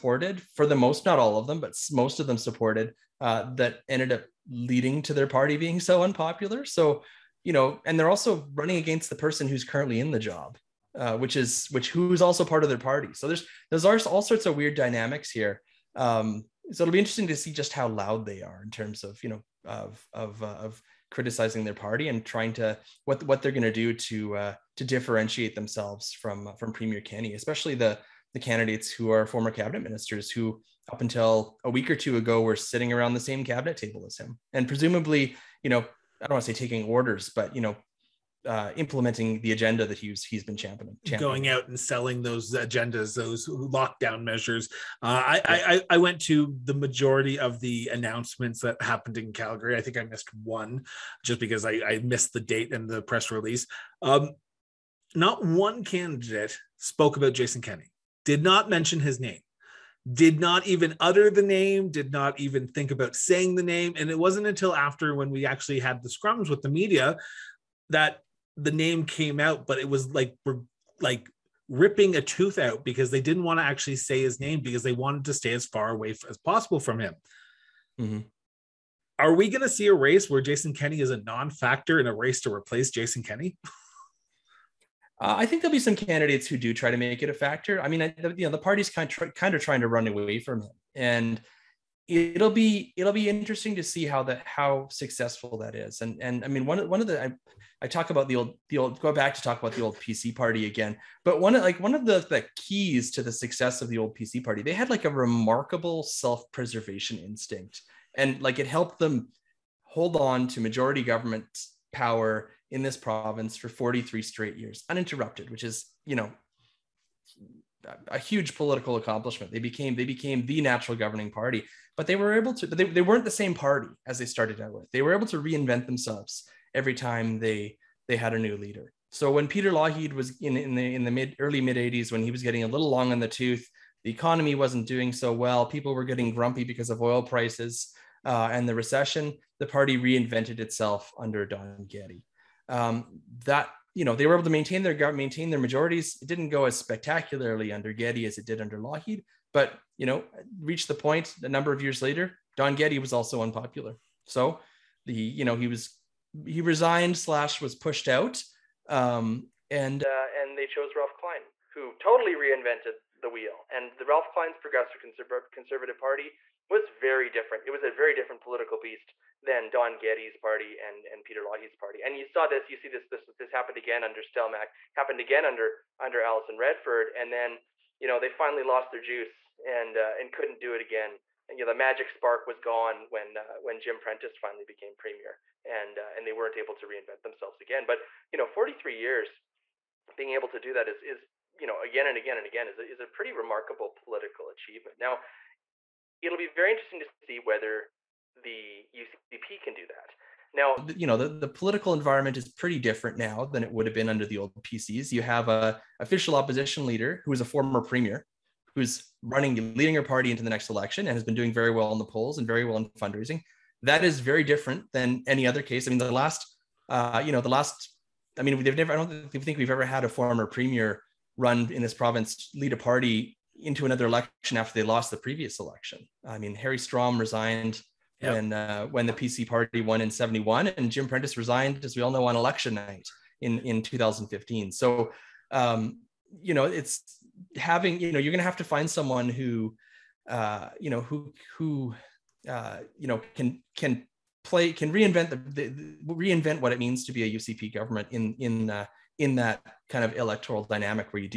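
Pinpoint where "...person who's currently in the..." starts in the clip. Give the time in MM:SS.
00:09.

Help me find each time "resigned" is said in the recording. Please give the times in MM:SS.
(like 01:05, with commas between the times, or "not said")
02:36, 03:47, 03:51.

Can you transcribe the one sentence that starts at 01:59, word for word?
They became they became the natural governing party, but they were able to.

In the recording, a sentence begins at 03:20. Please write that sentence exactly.
Now, you know, the, the political environment is pretty different now than it would have been under the old PCs.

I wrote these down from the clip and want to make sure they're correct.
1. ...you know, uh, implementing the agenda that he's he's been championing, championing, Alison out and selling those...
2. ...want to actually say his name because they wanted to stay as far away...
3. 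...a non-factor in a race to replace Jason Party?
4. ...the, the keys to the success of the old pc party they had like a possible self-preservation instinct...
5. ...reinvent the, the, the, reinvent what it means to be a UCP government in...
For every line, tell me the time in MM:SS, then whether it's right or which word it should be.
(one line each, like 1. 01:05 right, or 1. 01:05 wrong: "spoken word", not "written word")
1. 00:37 wrong: "Going", not "Alison"
2. 01:13 right
3. 01:21 wrong: "Kenney", not "Party"
4. 01:42 wrong: "remarkable", not "possible"
5. 04:04 right.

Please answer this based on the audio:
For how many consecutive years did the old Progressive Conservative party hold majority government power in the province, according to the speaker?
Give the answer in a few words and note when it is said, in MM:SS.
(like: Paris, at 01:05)
43, at 01:53.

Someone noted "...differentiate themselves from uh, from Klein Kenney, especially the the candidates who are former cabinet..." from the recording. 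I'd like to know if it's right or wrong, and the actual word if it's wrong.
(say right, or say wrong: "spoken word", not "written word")
wrong: "Premier", not "Klein".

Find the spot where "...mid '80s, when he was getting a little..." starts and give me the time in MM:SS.
02:11.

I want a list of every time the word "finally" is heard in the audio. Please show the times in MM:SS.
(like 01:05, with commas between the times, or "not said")
02:58, 03:04.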